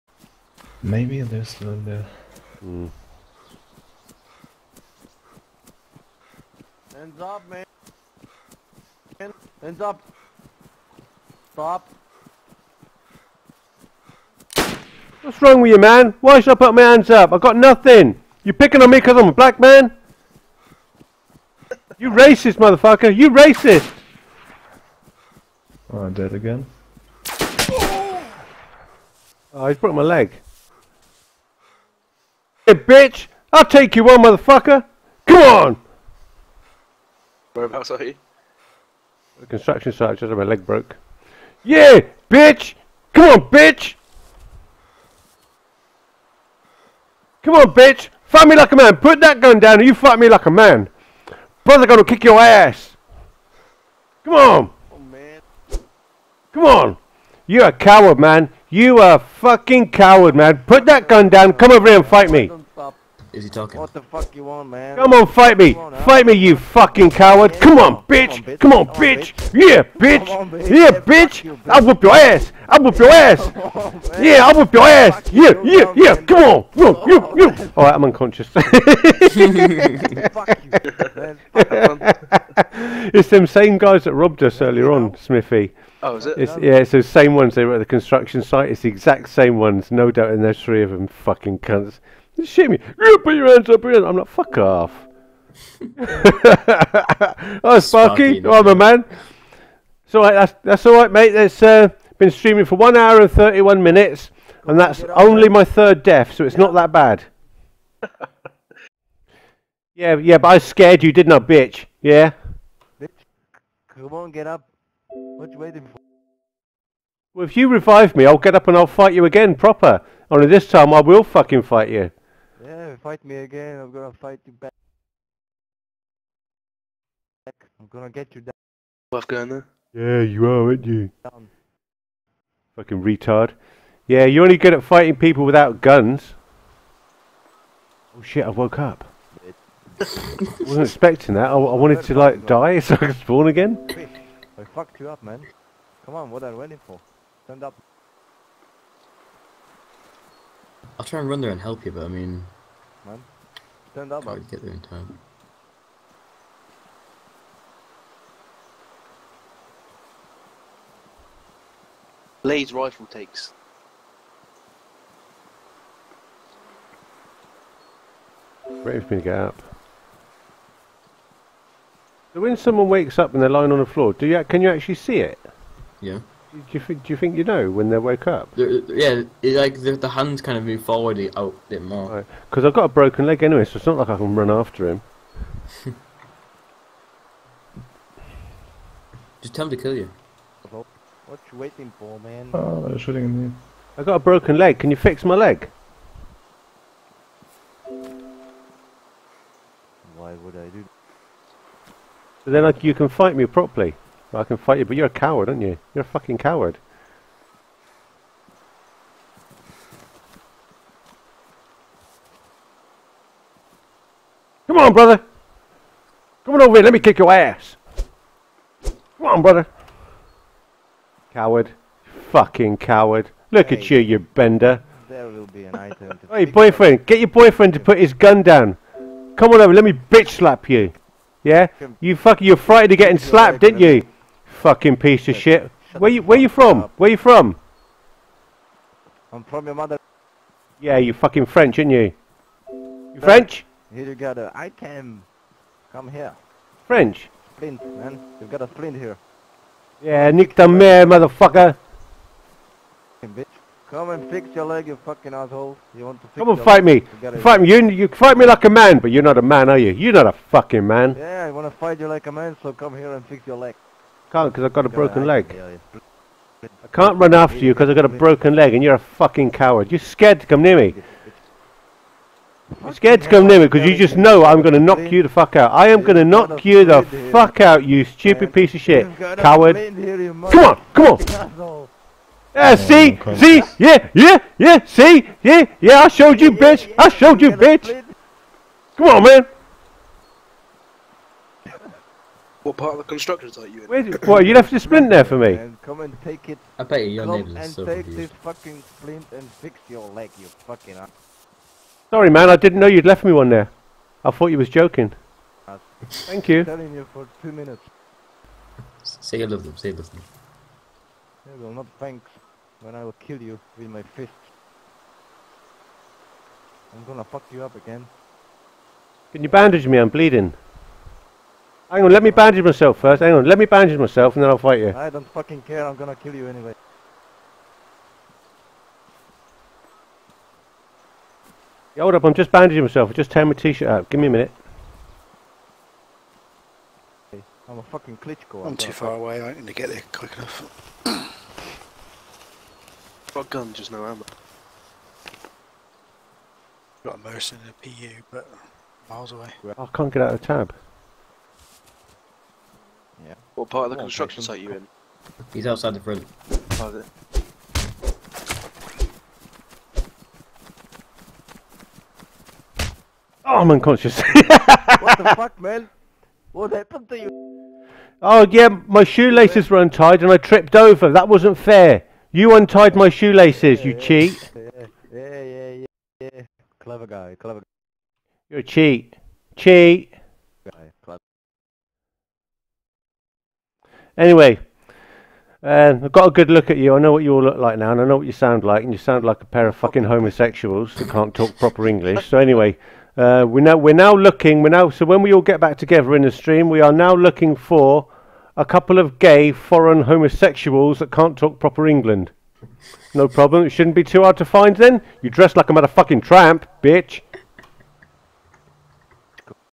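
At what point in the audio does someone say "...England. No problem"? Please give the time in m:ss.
6:41.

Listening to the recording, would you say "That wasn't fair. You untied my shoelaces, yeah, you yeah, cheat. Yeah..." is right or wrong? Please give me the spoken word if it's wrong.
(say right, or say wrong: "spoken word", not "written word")
right.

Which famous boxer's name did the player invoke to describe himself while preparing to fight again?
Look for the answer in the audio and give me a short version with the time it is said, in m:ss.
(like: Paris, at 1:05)
Klitschko, at 5:38.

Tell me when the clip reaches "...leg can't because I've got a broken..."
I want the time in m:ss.
4:23.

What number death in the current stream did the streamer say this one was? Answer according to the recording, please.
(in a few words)
Third.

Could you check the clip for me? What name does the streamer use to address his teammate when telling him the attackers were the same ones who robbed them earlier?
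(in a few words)
Smithy.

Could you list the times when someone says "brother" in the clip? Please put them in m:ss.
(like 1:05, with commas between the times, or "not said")
0:51, 3:34, 3:39.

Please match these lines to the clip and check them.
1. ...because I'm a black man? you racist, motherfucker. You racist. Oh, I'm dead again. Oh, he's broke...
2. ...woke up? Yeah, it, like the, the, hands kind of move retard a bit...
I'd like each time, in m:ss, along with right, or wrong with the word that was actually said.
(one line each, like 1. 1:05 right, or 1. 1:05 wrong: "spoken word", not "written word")
1. 0:18 right
2. 2:57 wrong: "forward", not "retard".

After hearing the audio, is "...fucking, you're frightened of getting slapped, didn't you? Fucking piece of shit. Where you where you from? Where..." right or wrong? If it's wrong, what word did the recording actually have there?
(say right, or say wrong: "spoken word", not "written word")
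right.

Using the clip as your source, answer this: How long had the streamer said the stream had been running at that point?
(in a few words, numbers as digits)
1 hour 31 minutes.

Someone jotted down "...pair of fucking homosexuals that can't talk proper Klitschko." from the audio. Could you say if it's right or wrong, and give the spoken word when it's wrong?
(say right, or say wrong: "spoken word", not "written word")
wrong: "English", not "Klitschko".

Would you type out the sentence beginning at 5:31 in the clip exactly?
Yeah, hold up, I'm just bandaging myself.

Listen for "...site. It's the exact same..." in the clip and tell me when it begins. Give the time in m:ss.
1:28.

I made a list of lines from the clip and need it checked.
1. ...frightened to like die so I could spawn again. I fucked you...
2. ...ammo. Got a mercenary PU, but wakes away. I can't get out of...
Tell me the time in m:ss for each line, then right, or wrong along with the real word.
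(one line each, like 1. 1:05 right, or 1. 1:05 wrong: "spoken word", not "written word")
1. 2:21 wrong: "wanted", not "frightened"
2. 5:44 wrong: "miles", not "wakes".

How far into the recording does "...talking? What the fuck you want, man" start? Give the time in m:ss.
1:03.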